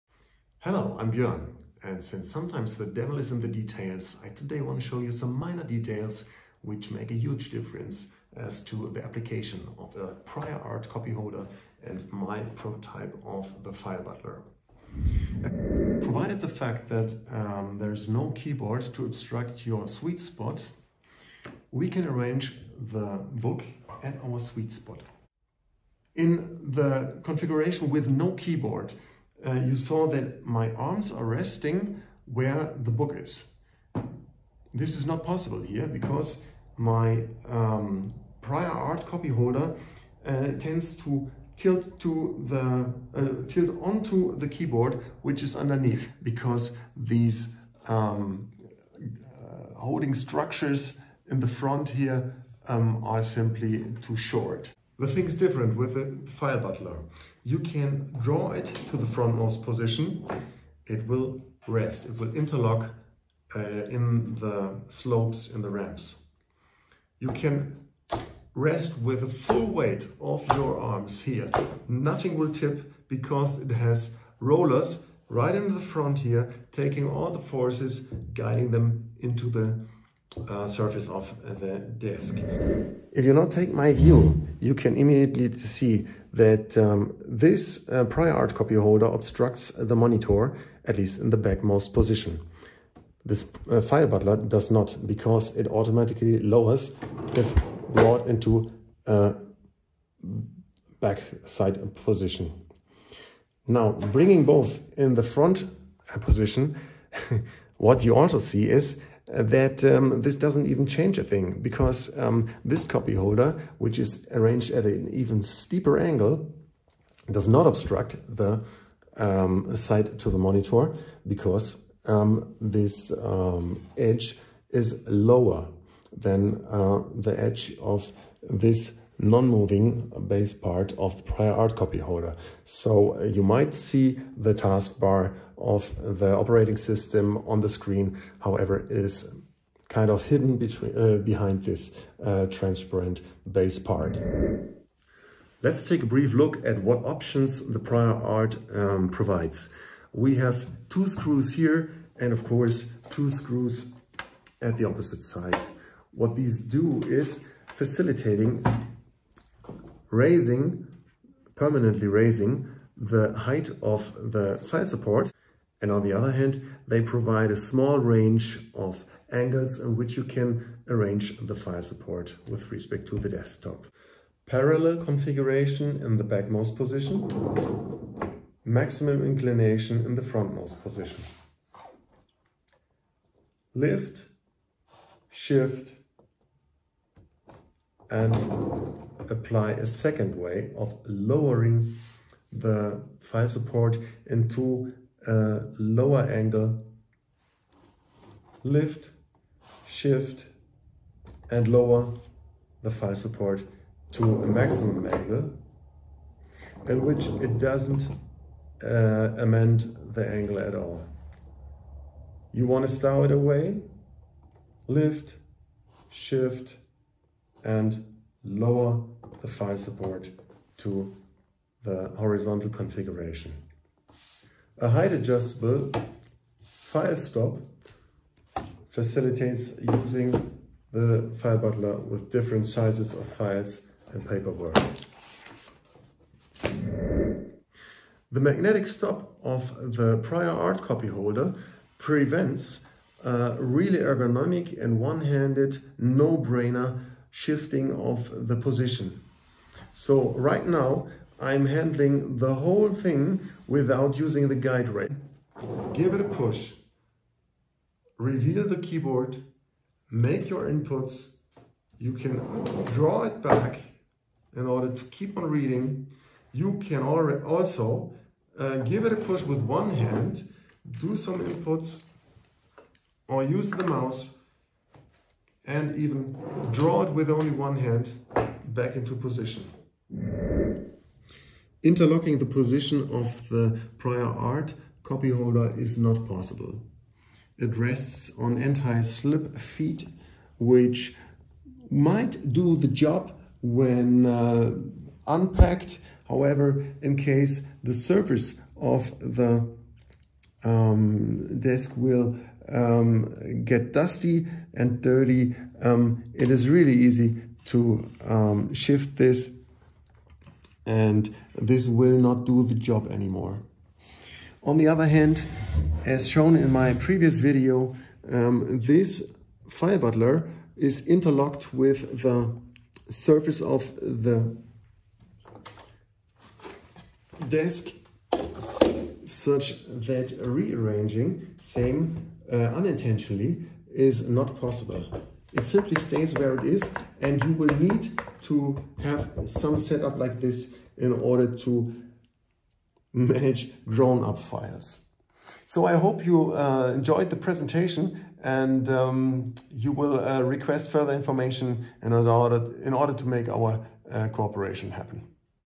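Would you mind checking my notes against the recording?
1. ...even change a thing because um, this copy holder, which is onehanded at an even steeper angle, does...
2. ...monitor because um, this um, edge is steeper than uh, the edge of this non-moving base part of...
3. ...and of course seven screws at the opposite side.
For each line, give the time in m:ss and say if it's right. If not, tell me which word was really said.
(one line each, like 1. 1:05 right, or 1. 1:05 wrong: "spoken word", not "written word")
1. 1:50 wrong: "arranged", not "onehanded"
2. 2:00 wrong: "lower", not "steeper"
3. 2:32 wrong: "two", not "seven".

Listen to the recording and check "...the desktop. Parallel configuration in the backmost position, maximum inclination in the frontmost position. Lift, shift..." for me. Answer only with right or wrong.
right.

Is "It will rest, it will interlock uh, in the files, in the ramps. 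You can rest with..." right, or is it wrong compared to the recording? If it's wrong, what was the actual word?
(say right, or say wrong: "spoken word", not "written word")
wrong: "slopes", not "files".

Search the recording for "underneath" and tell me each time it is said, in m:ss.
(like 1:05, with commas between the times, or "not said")
0:45.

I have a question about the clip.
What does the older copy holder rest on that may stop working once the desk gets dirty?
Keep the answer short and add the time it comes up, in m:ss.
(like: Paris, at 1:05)
anti-slip feet, at 4:48.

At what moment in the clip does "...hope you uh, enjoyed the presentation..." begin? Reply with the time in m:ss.
5:45.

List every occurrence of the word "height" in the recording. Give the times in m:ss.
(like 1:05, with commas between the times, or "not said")
2:43, 3:44.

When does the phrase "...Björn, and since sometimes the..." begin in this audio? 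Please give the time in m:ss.
0:01.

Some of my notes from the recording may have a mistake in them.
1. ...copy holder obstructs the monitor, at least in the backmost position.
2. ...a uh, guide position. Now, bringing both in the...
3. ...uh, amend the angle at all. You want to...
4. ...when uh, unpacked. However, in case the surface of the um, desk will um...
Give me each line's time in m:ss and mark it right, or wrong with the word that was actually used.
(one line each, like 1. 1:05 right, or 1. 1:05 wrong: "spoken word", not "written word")
1. 1:28 right
2. 1:39 wrong: "backside", not "guide"
3. 3:28 right
4. 4:53 right.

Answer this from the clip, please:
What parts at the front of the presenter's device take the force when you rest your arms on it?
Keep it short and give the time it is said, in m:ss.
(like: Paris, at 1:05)
rollers, at 1:14.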